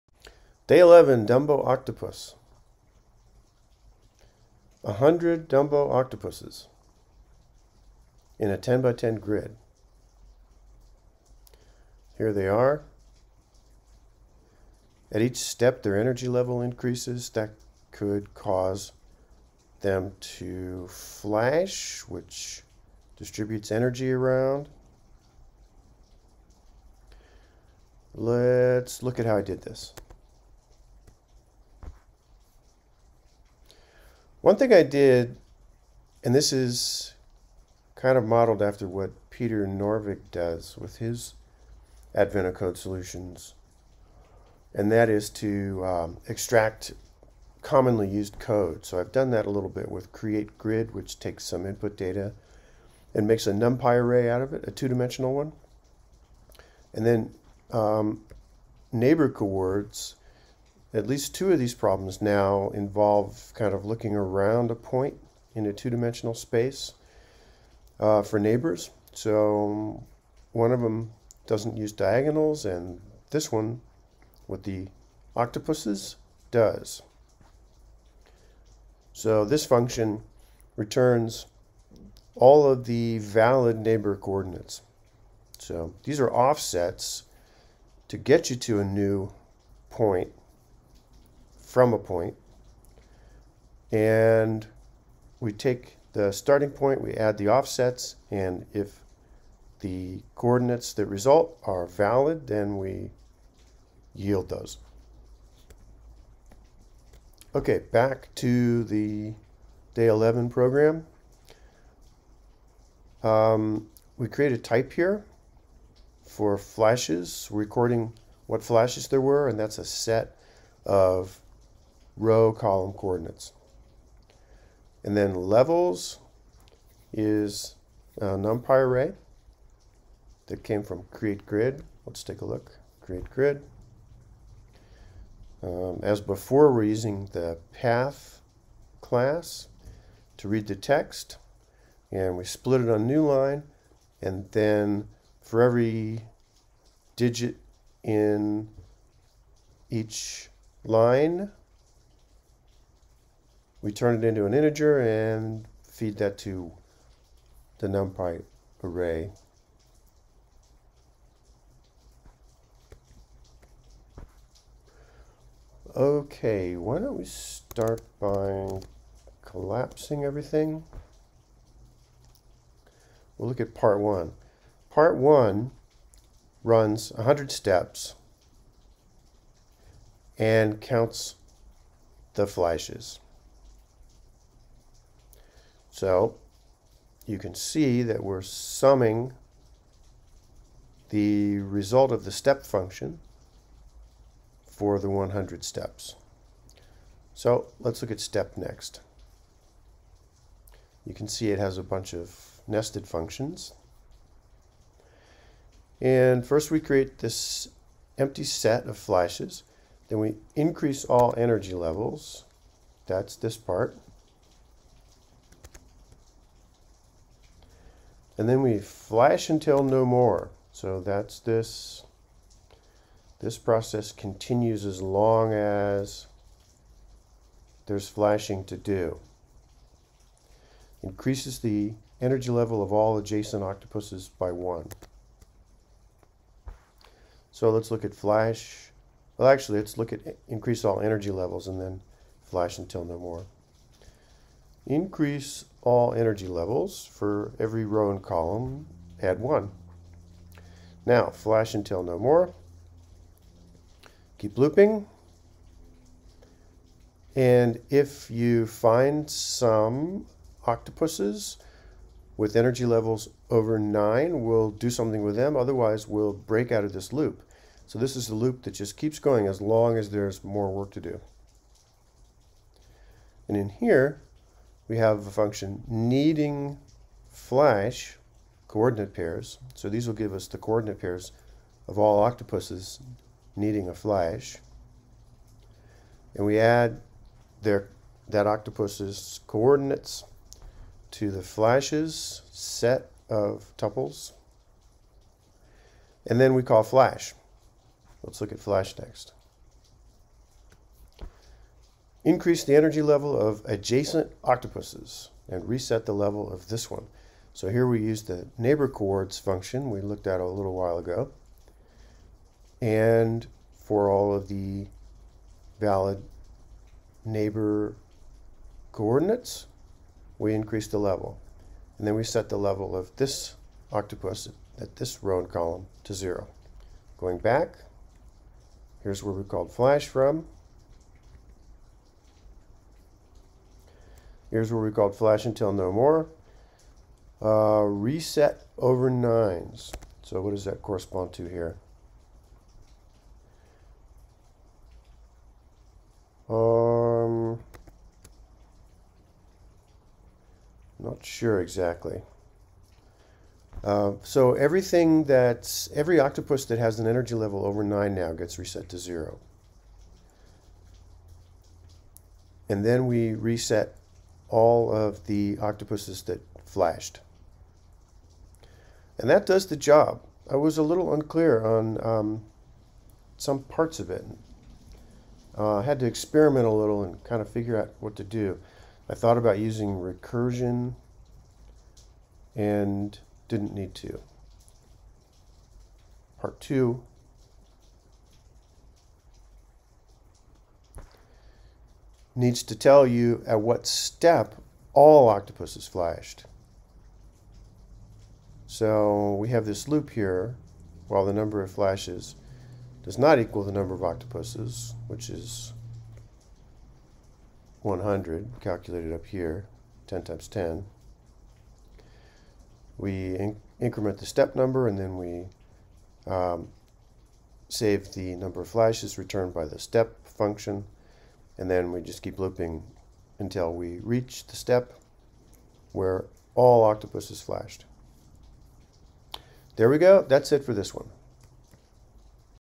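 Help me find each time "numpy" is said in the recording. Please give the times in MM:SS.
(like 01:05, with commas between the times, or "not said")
00:53, 02:08, 02:37.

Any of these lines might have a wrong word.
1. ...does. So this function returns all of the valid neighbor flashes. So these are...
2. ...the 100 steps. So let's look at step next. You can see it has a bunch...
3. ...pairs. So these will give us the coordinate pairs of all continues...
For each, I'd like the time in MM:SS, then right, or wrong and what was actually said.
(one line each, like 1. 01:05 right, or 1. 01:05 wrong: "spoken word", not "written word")
1. 01:16 wrong: "coordinates", not "flashes"
2. 03:14 right
3. 04:39 wrong: "octopuses", not "continues".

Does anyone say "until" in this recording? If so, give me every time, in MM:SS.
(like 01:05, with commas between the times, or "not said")
03:39, 04:02, 04:11, 05:35, 07:03.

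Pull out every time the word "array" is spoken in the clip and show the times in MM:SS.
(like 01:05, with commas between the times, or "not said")
00:53, 02:08, 02:38.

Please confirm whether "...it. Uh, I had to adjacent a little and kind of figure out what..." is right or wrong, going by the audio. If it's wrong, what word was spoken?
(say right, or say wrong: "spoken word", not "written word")
wrong: "experiment", not "adjacent".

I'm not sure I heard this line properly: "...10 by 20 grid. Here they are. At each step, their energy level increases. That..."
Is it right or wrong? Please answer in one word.
wrong.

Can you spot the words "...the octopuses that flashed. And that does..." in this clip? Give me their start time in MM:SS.
06:05.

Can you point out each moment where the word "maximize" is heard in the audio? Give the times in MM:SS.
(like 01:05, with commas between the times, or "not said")
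not said.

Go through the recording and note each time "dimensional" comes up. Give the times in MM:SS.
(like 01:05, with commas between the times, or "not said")
00:54, 01:05.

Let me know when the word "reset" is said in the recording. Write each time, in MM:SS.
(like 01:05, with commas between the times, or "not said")
05:05, 05:37, 05:58, 06:03.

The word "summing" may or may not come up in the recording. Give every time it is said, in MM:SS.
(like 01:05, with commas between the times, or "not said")
03:08.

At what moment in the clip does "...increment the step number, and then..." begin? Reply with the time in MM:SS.
06:53.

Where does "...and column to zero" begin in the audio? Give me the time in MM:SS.
05:25.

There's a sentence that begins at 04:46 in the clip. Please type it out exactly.
And we add their that octopus's coordinates to the flashes set of tuples.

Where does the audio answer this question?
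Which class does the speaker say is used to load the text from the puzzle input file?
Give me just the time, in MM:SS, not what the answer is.
02:17.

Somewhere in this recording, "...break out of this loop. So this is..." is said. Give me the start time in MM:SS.
04:26.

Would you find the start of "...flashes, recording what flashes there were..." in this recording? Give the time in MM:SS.
01:56.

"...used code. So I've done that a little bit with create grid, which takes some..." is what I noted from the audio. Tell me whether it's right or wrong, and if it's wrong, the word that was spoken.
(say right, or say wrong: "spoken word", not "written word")
right.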